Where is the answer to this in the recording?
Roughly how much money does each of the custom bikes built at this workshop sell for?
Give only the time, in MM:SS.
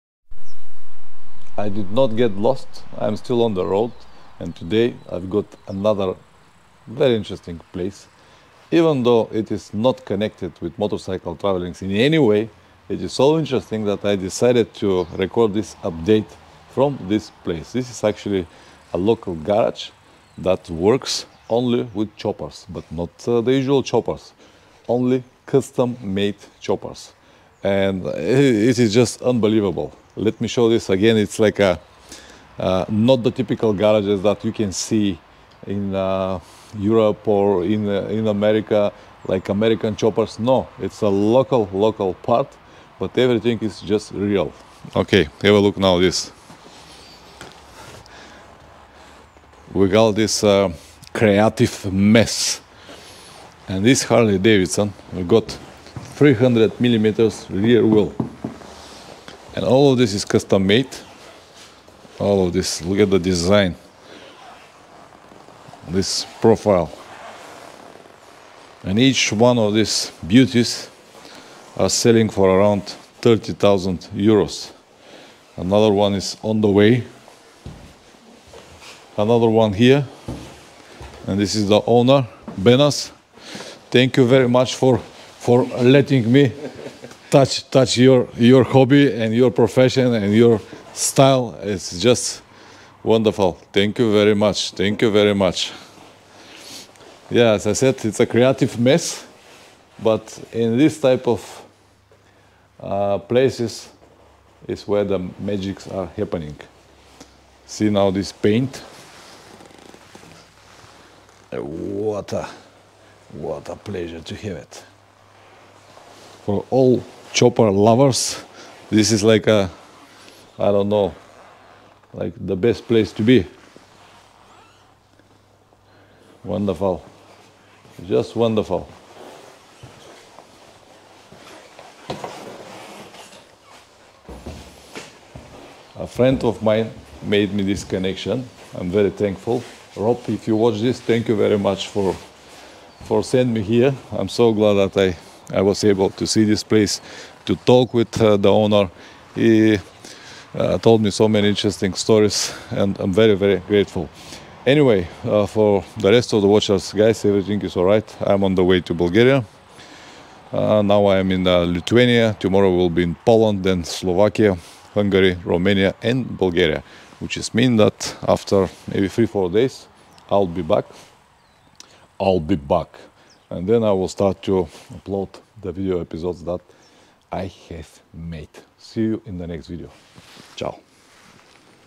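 01:13.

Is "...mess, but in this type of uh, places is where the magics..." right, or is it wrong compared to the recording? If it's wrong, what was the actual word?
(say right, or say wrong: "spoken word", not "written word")
right.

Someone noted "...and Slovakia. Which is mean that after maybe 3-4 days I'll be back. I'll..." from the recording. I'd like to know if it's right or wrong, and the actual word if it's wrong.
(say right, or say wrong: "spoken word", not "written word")
wrong: "Bulgaria", not "Slovakia".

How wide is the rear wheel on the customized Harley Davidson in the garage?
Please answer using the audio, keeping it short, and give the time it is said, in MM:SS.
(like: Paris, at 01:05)
300 millimeters, at 00:56.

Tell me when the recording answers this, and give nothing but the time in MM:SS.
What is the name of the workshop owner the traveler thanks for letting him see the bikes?
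01:22.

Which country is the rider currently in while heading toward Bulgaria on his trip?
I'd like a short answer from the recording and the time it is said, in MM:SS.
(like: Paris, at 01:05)
Lithuania, at 02:41.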